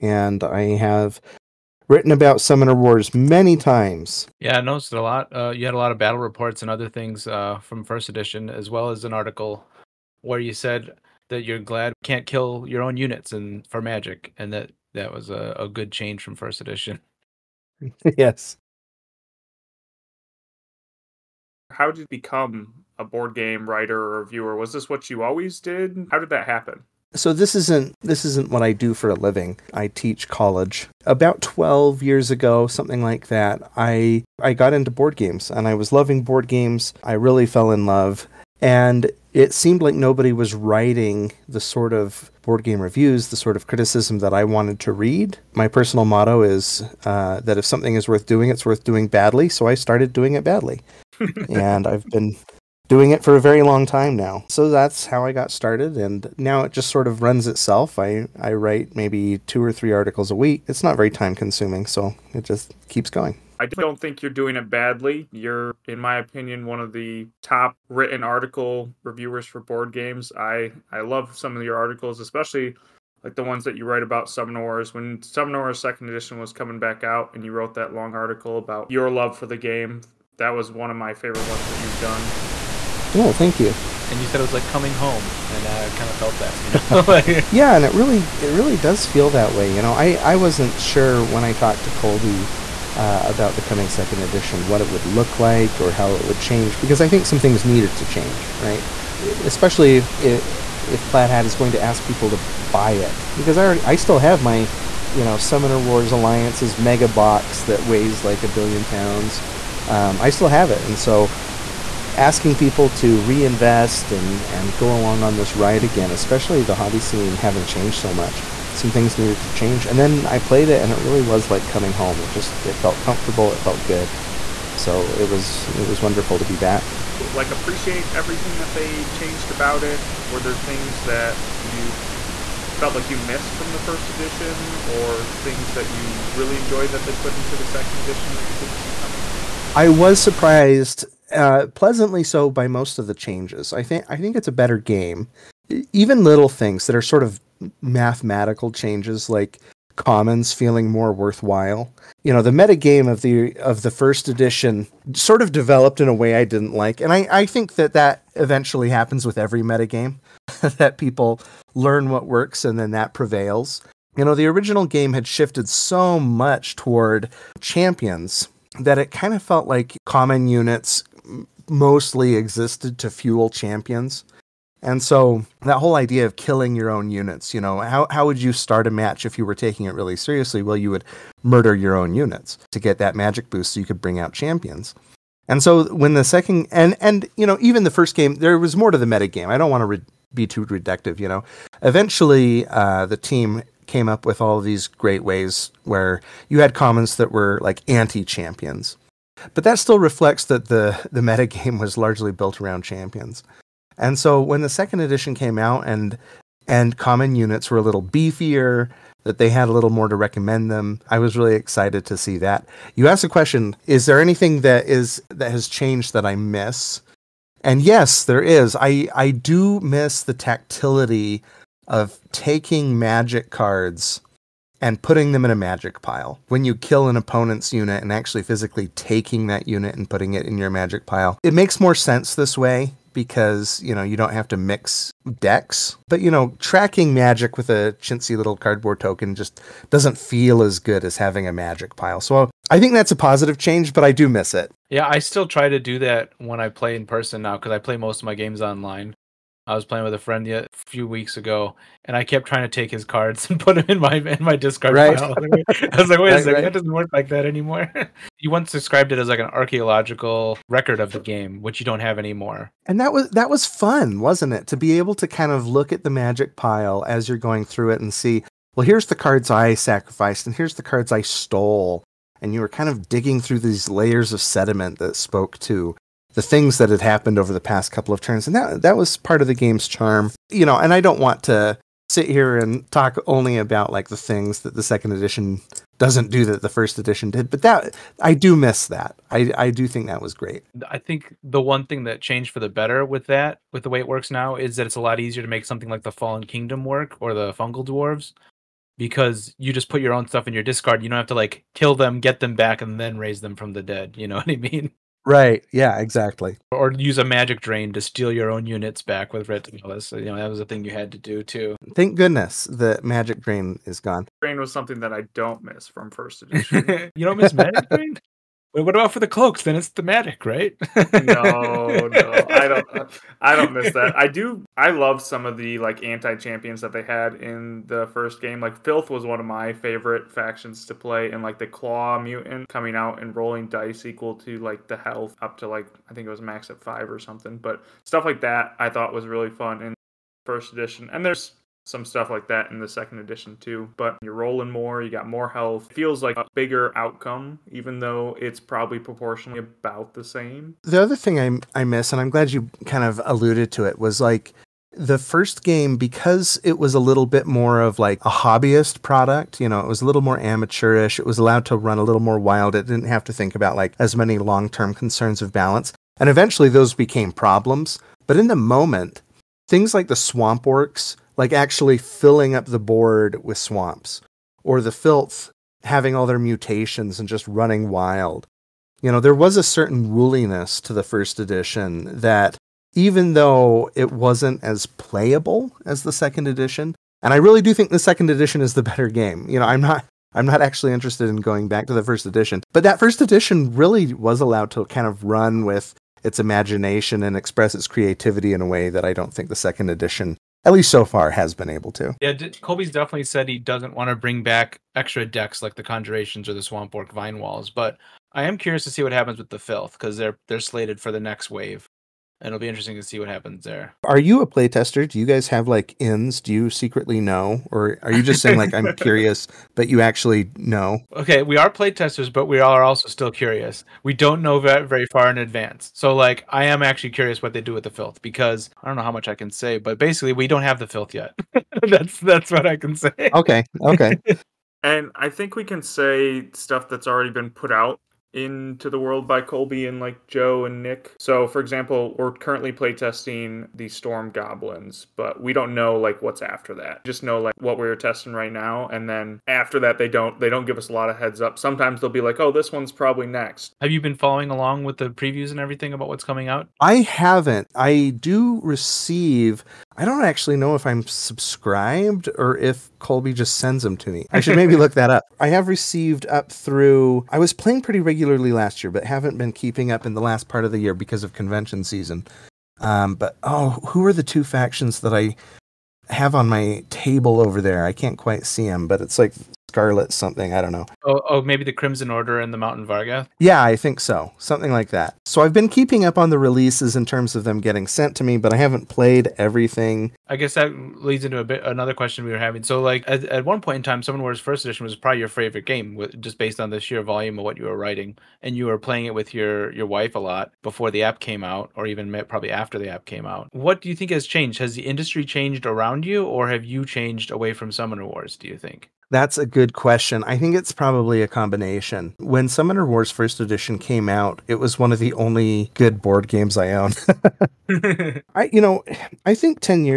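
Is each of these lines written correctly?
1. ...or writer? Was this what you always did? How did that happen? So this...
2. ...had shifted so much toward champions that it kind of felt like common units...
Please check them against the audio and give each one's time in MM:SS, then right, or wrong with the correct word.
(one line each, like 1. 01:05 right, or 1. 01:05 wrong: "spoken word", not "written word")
1. 00:23 wrong: "reviewer", not "writer"
2. 02:45 right.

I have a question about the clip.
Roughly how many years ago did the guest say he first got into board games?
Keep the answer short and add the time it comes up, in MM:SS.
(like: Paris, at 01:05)
12, at 00:31.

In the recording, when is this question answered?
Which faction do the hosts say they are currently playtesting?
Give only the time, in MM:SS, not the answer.
07:23.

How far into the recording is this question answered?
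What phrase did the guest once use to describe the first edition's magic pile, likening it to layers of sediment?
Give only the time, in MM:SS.
04:19.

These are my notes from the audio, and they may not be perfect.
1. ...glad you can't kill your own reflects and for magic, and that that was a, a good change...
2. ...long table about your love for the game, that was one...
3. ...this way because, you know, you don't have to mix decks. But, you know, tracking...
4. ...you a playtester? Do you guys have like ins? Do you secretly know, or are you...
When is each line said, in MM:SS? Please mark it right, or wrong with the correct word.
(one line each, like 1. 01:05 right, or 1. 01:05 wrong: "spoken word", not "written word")
1. 00:11 wrong: "units", not "reflects"
2. 01:17 wrong: "article", not "table"
3. 03:52 right
4. 06:54 right.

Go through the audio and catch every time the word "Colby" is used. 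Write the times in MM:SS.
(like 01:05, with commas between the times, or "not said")
01:31, 06:42, 07:19, 07:42.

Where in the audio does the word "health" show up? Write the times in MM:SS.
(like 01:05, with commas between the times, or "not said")
05:34, 05:45.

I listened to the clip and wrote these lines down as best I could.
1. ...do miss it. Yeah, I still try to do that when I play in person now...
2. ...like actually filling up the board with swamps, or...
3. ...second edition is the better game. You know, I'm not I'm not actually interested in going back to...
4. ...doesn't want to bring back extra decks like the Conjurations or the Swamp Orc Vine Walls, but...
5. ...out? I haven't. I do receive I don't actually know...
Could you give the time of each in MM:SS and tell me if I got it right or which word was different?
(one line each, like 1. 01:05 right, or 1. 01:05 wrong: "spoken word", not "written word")
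1. 04:04 right
2. 06:11 right
3. 06:27 right
4. 06:43 right
5. 07:36 right.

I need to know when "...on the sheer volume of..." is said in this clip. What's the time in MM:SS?
08:16.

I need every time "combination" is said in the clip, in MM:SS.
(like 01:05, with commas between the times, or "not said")
08:31.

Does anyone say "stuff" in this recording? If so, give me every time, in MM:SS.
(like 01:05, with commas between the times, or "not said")
05:00, 05:38, 05:42, 07:16.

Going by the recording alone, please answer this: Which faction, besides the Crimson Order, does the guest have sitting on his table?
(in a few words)
Mountain Vargath.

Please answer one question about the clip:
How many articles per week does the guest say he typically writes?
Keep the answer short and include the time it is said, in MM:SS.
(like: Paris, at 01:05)
Two or three, at 00:59.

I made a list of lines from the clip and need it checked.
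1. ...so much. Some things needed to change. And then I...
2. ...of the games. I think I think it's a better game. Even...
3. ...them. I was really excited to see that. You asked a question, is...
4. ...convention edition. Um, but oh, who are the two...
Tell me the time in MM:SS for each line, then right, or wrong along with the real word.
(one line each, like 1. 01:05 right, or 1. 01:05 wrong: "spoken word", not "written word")
1. 01:57 right
2. 02:22 wrong: "changes", not "games"
3. 03:30 right
4. 07:51 wrong: "season", not "edition".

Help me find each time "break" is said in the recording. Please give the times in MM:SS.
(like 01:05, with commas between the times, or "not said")
not said.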